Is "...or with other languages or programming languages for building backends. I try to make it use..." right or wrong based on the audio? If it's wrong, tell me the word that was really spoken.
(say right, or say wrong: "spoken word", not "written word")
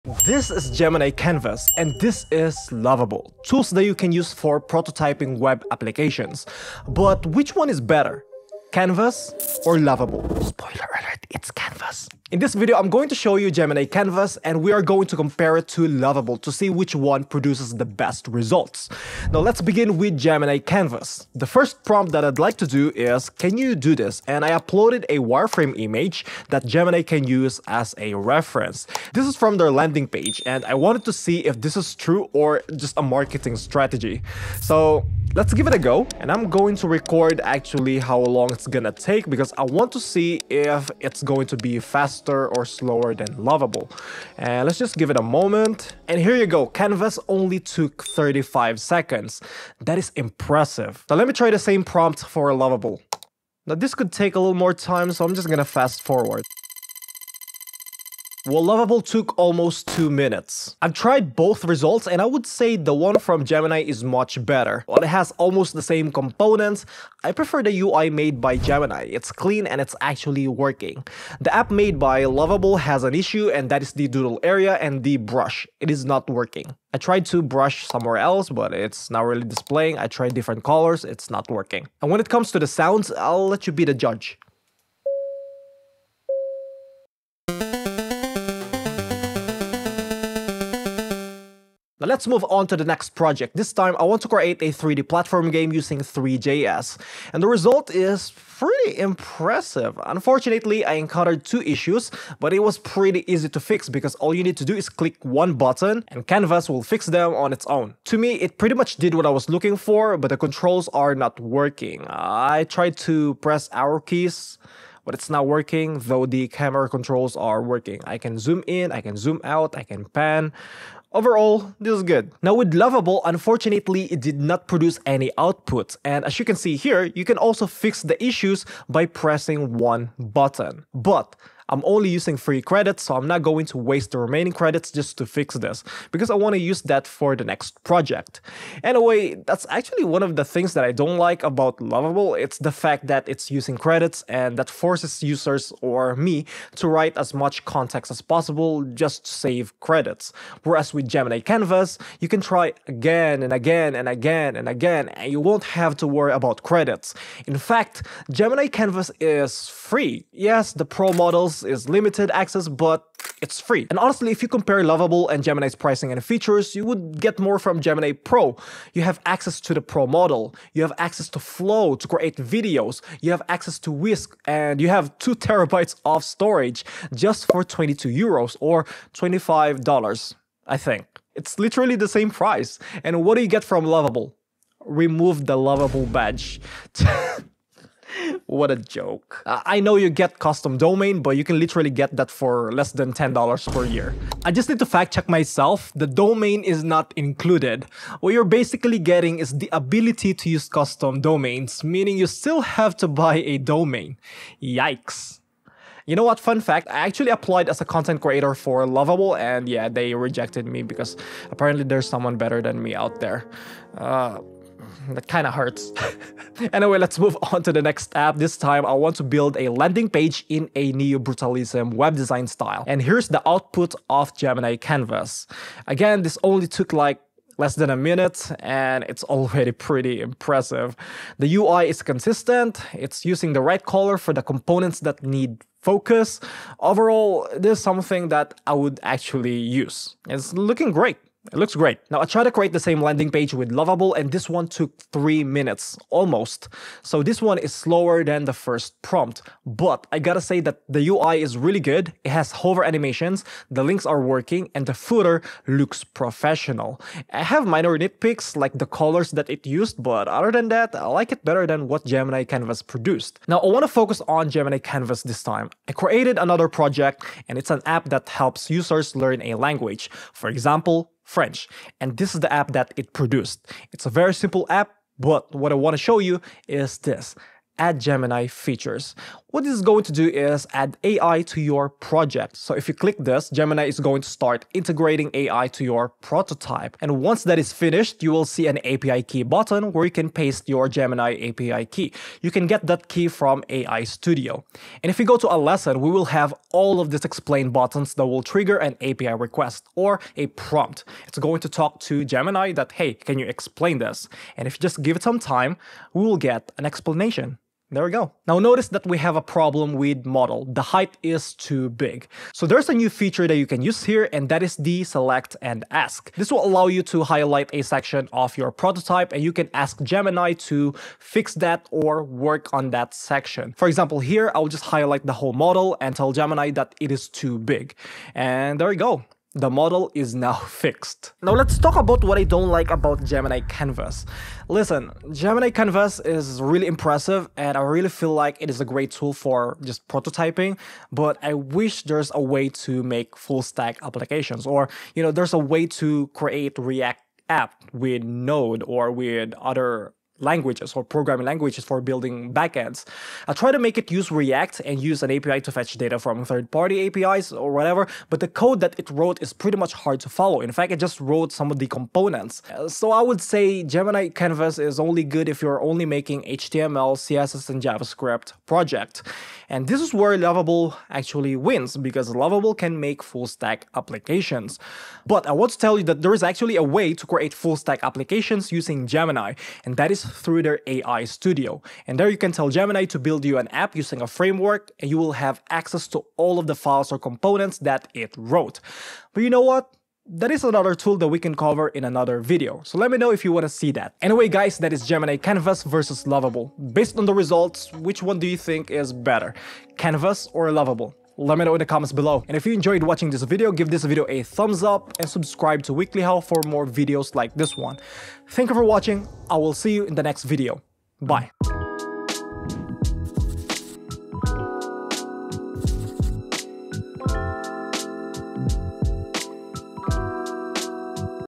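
right.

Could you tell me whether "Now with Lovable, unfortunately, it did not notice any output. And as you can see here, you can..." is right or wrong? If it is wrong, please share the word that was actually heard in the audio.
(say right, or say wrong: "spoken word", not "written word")
wrong: "produce", not "notice".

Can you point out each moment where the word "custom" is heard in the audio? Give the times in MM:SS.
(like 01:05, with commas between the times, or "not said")
03:10, 03:20.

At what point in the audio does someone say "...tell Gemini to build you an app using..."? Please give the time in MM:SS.
06:22.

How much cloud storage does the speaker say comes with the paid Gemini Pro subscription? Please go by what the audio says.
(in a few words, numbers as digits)
2 terabytes.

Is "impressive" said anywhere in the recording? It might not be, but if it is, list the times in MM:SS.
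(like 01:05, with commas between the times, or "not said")
00:50, 01:38, 03:50, 05:36.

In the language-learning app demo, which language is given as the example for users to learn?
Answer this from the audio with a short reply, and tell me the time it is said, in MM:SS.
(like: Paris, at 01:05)
French, at 04:31.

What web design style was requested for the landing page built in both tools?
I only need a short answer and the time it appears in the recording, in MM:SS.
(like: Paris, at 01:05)
Neo-brutalism, at 03:40.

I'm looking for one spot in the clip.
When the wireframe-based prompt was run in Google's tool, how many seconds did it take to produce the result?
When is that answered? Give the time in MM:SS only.
00:48.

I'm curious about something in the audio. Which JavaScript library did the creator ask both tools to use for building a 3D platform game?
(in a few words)
3JS.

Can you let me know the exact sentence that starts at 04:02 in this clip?
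Now I tried to create the same landing page with Lovable and this one took three minutes, almost.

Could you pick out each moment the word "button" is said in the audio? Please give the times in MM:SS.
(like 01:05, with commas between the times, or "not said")
01:45, 02:10, 04:49, 04:57.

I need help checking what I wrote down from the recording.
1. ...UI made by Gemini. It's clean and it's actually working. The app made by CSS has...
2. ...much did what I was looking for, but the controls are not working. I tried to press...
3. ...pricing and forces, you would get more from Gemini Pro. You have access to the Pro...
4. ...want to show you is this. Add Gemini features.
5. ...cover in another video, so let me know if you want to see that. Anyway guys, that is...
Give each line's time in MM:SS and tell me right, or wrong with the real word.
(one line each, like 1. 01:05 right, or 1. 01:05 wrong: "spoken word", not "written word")
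1. 01:07 wrong: "Lovable", not "CSS"
2. 01:48 right
3. 02:45 wrong: "features", not "forces"
4. 04:35 right
5. 06:31 right.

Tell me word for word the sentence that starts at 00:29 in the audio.
This is from their landing page and I wanted to see if this is true or just a marketing strategy.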